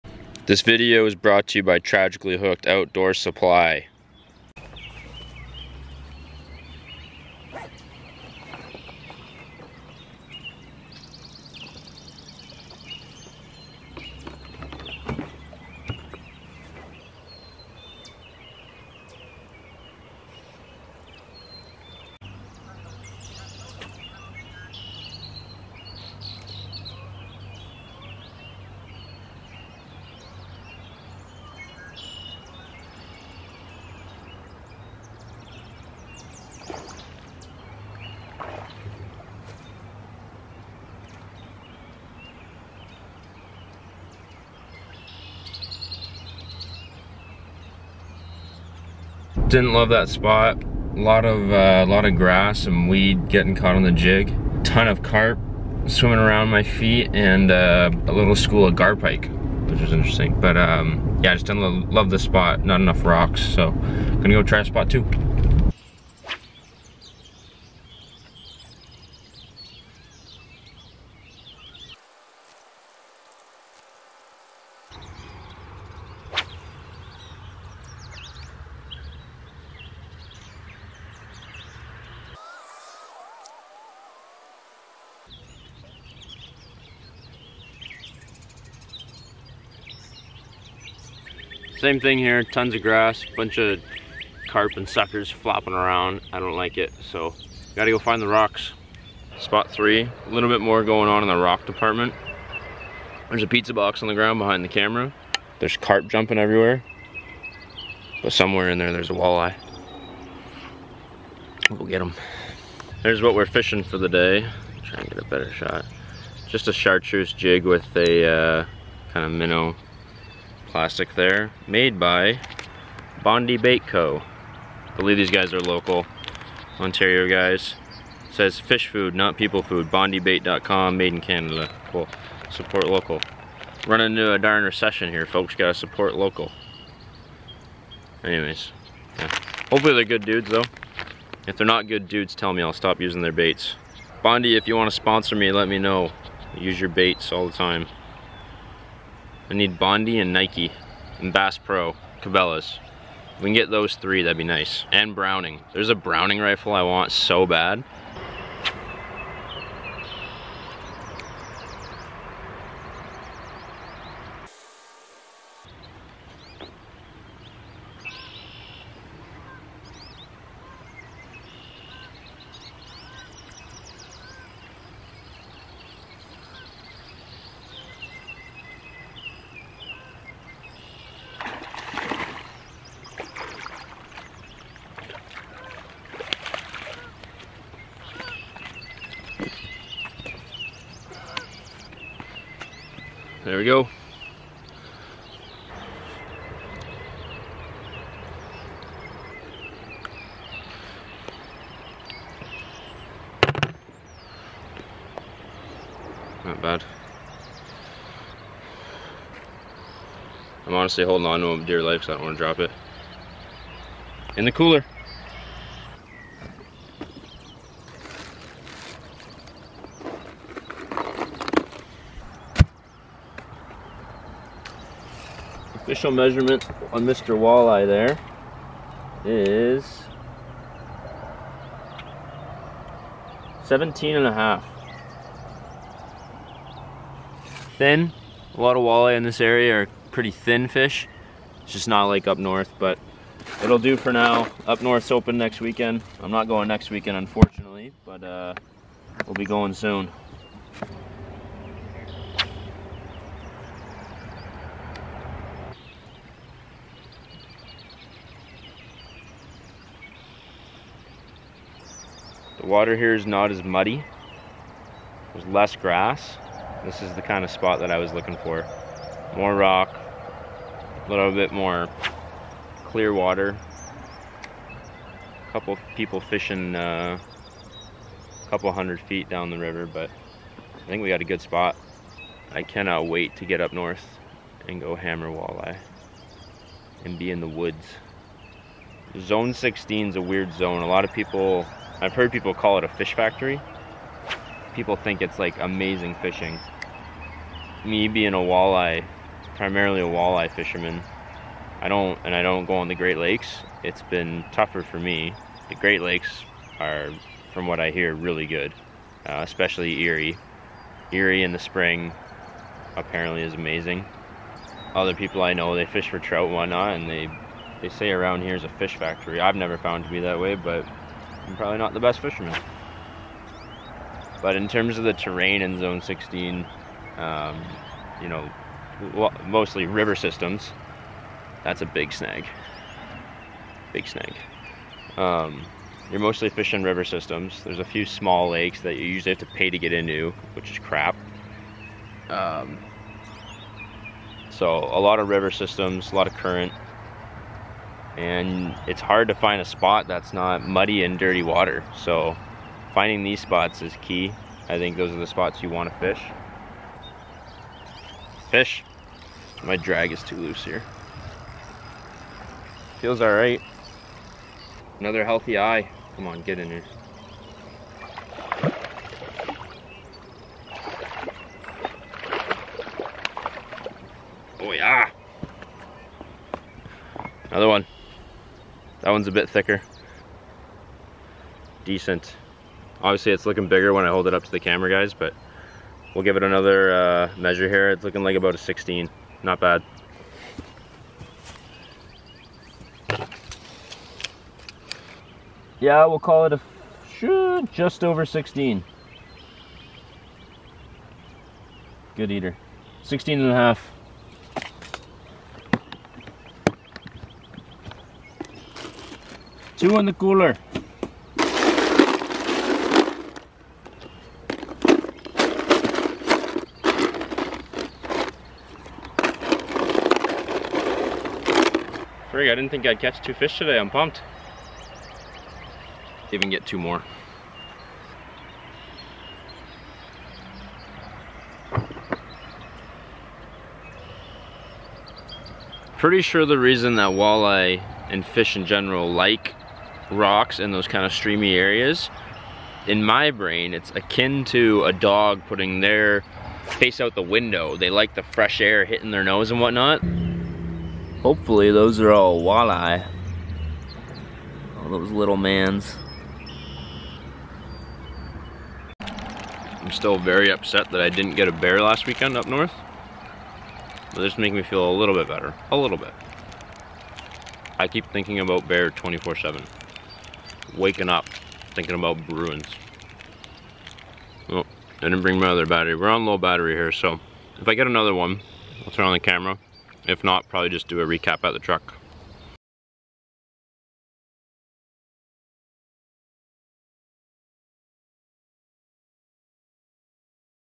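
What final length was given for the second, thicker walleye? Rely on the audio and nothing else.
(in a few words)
16.5.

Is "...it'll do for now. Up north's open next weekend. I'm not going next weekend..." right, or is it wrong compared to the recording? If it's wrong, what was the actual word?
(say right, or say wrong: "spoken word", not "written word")
right.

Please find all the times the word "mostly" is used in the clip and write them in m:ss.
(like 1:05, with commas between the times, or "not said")
5:29, 5:36.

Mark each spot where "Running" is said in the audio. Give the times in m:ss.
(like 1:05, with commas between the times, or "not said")
2:13.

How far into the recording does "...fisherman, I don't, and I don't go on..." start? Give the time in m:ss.
5:00.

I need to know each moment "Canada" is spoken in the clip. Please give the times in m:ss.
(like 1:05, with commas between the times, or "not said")
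2:11.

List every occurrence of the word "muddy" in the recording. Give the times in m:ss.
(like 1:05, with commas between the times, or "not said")
4:23, 5:50.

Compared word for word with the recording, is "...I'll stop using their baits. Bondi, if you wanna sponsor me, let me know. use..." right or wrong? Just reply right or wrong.
right.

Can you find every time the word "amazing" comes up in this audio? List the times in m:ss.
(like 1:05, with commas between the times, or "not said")
4:55, 5:13.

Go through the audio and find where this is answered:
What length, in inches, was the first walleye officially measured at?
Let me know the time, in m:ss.
3:53.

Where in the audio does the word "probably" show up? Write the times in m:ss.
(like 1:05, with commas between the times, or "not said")
5:21, 8:00.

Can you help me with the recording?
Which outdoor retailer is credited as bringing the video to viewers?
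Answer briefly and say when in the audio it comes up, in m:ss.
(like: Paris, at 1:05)
Tragically Hooked Outdoor Supply, at 0:01.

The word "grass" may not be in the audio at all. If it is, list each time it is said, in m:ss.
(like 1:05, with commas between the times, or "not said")
0:52, 1:32, 4:25.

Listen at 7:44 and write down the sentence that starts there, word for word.
But this makes me feel a little bit better.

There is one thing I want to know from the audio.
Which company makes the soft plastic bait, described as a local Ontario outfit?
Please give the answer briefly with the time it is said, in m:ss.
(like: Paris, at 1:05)
Bondi Bait Co., at 2:03.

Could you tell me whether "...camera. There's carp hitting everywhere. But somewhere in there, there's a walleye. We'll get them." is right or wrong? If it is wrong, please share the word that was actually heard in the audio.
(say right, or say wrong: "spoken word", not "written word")
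wrong: "jumping", not "hitting".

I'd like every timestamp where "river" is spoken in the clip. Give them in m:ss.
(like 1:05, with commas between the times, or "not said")
4:39, 5:29, 5:36, 5:45.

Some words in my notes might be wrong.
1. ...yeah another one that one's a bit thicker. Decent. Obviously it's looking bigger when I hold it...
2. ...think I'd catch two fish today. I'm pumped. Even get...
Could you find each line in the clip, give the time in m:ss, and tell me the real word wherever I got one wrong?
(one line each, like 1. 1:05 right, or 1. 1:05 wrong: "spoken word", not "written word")
1. 6:14 right
2. 7:02 right.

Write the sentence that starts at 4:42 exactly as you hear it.
I cannot wait to get up north and go hammer walleye and be in the woods.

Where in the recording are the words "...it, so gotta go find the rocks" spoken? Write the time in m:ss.
1:36.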